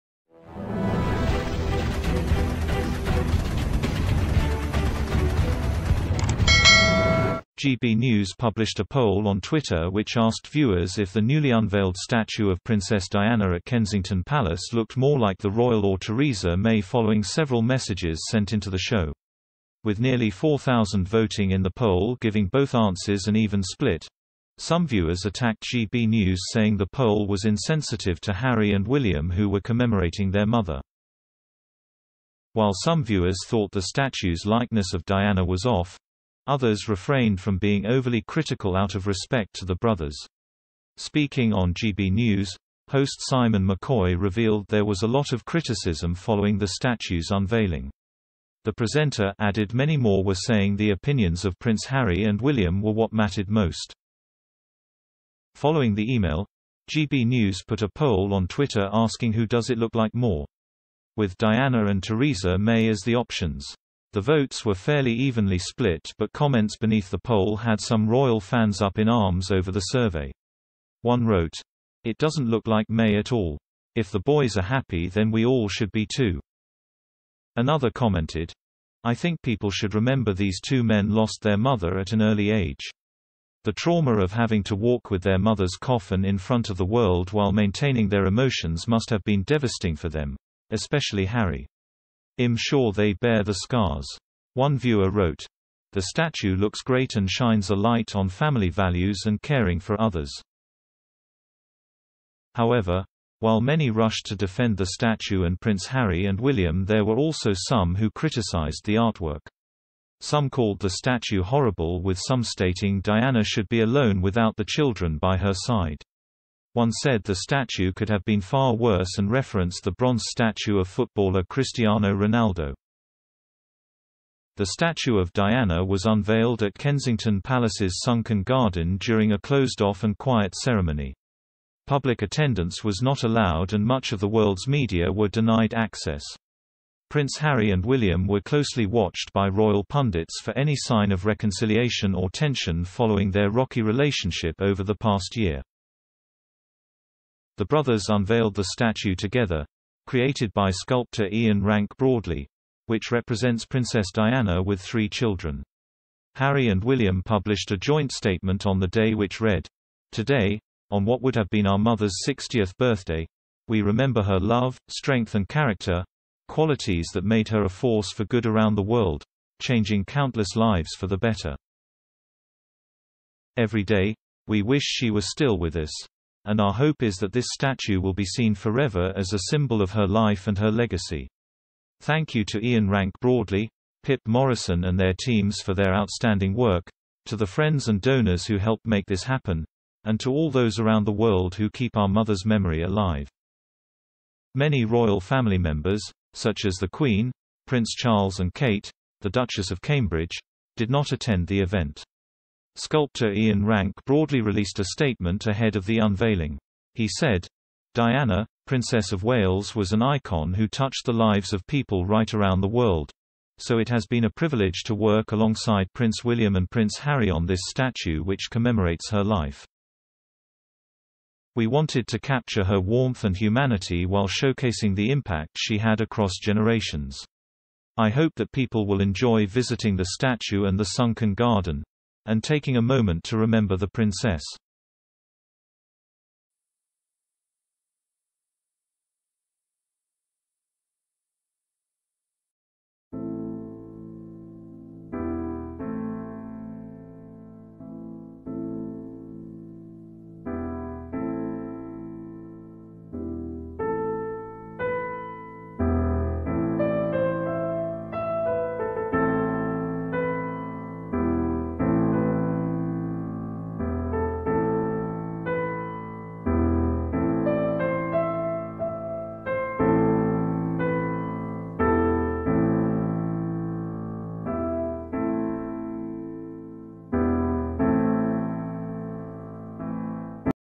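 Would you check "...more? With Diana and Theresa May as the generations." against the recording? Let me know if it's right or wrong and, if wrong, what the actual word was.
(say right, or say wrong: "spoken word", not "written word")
wrong: "options", not "generations".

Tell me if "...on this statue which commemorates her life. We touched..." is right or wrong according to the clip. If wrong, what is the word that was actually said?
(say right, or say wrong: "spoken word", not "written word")
wrong: "wanted", not "touched".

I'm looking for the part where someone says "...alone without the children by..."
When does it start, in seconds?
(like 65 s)
113 s.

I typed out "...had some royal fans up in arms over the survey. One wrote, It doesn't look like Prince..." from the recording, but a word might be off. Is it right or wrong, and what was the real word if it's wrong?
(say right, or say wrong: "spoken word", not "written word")
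wrong: "May", not "Prince".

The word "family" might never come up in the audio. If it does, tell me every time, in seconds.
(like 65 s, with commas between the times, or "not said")
98 s, 195 s.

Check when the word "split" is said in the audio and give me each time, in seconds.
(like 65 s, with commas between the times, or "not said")
23 s, 65 s.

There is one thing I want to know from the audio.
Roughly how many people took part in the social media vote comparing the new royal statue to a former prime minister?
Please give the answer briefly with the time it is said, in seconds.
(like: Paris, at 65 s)
nearly 4,000, at 19 s.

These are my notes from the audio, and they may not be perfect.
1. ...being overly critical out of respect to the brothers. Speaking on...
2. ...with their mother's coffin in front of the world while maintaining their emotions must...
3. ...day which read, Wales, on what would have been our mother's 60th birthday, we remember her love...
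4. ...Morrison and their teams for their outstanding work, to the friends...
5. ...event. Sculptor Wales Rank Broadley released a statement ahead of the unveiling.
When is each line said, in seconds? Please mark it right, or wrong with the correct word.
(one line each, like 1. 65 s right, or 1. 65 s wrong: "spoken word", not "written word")
1. 37 s right
2. 85 s right
3. 158 s wrong: "Today", not "Wales"
4. 184 s right
5. 201 s wrong: "Ian", not "Wales".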